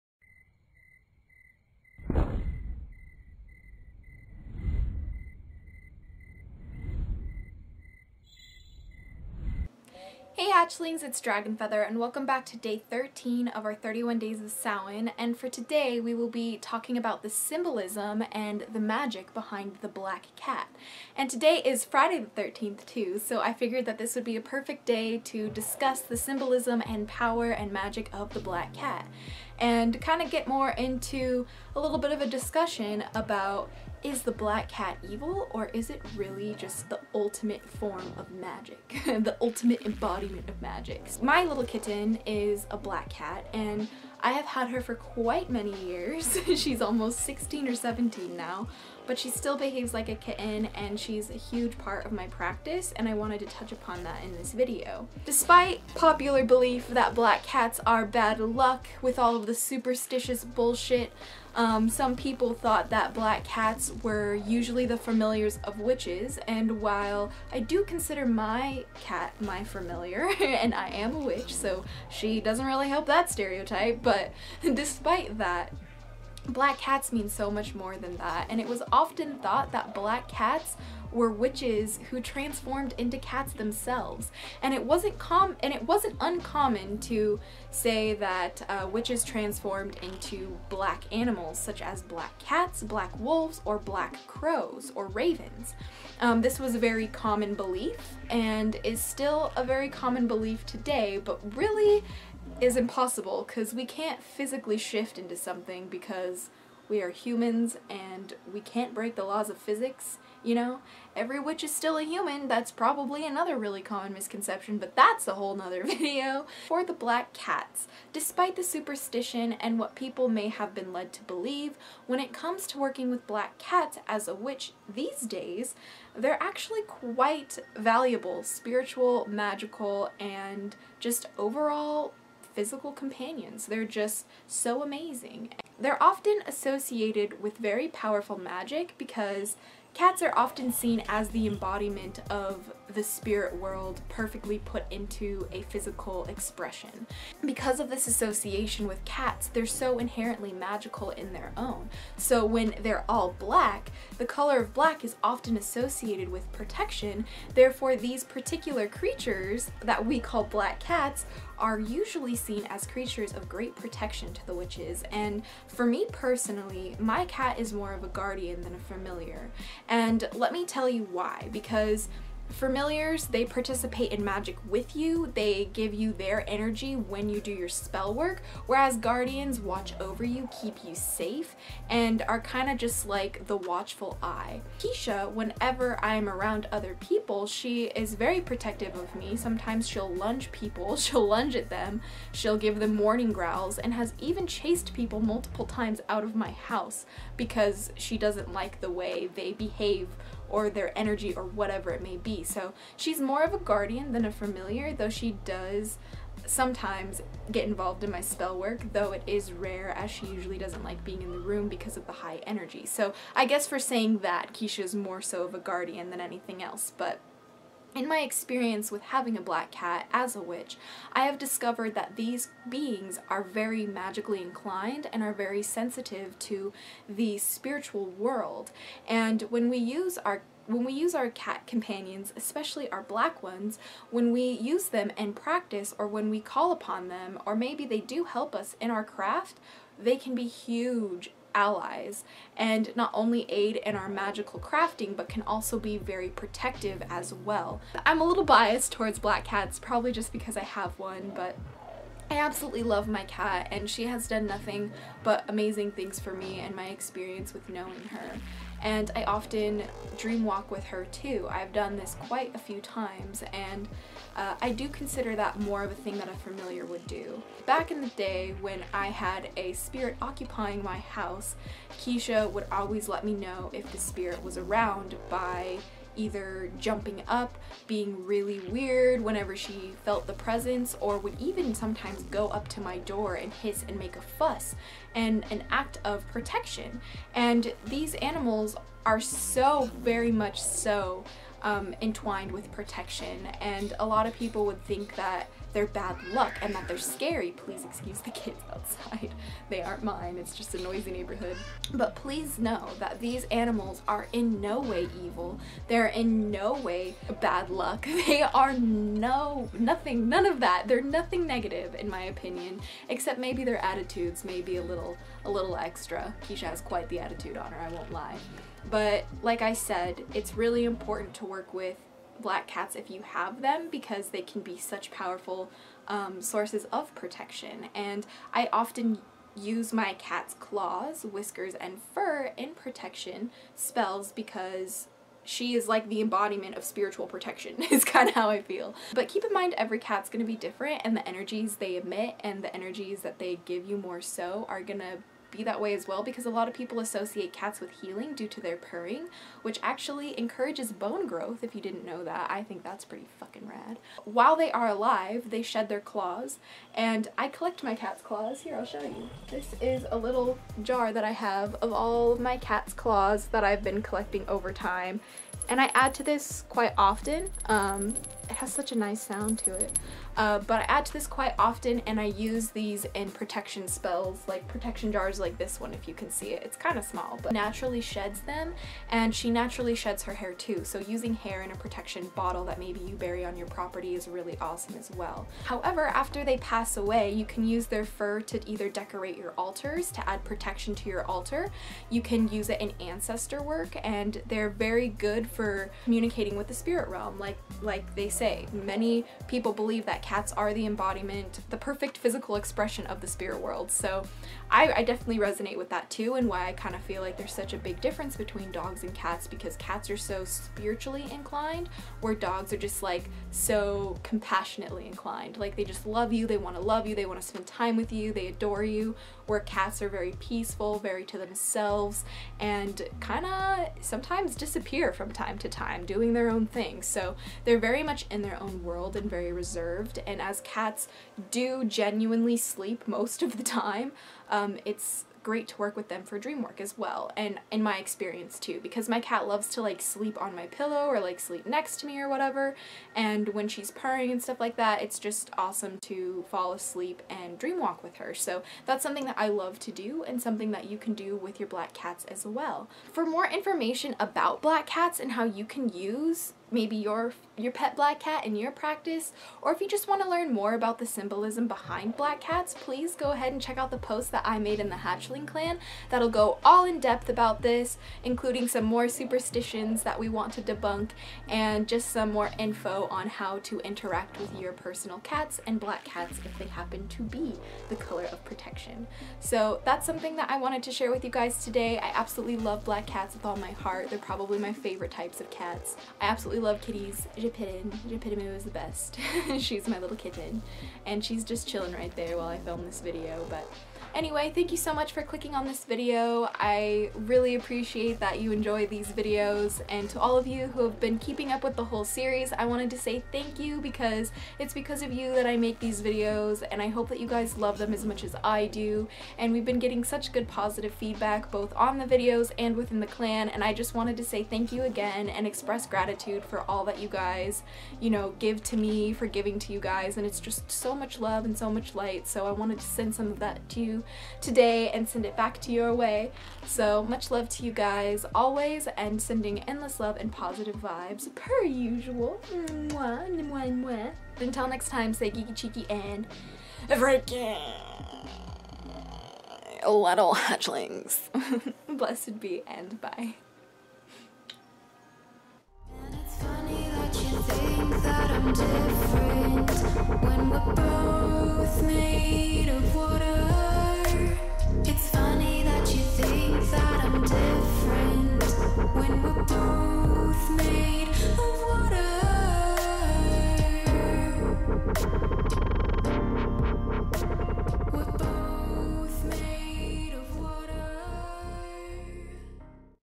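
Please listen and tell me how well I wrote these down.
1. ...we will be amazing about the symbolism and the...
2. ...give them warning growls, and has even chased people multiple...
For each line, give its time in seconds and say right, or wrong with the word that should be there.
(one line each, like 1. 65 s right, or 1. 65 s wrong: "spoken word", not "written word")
1. 15 s wrong: "talking", not "amazing"
2. 192 s right.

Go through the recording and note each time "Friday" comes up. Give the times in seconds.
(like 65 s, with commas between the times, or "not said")
21 s.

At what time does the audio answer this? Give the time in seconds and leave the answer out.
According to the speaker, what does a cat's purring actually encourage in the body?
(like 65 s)
350 s.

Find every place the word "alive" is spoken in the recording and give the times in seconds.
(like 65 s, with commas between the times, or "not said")
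354 s.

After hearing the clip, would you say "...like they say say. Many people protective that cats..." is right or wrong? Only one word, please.
wrong.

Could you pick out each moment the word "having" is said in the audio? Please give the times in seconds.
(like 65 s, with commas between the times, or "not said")
219 s.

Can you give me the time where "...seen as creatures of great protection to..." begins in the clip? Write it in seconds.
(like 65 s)
162 s.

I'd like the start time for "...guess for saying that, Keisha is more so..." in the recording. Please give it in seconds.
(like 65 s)
213 s.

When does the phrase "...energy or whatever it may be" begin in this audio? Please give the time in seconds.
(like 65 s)
200 s.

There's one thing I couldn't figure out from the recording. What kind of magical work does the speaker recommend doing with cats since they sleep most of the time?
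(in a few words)
dream work.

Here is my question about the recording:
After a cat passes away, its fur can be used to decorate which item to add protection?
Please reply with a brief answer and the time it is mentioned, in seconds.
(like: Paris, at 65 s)
altars, at 389 s.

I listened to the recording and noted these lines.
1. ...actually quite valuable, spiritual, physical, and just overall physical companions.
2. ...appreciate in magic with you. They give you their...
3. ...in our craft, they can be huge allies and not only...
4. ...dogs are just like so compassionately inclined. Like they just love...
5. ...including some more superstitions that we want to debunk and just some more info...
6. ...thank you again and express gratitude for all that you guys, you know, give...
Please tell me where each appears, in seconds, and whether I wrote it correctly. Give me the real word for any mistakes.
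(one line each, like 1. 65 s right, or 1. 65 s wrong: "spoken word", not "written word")
1. 126 s wrong: "magical", not "physical"
2. 173 s wrong: "participate", not "appreciate"
3. 238 s right
4. 412 s right
5. 468 s right
6. 514 s right.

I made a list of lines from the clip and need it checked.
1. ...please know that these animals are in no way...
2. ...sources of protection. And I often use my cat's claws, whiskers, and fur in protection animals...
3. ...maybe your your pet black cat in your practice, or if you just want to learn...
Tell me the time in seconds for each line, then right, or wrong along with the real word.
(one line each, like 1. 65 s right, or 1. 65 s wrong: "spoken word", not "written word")
1. 302 s right
2. 326 s wrong: "spells", not "animals"
3. 456 s right.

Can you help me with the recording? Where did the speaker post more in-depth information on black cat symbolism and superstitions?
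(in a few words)
the Hatchling Clan.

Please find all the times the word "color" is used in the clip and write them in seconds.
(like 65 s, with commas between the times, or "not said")
154 s, 477 s.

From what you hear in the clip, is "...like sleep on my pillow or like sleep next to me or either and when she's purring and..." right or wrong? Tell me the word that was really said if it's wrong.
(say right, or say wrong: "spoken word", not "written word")
wrong: "whatever", not "either".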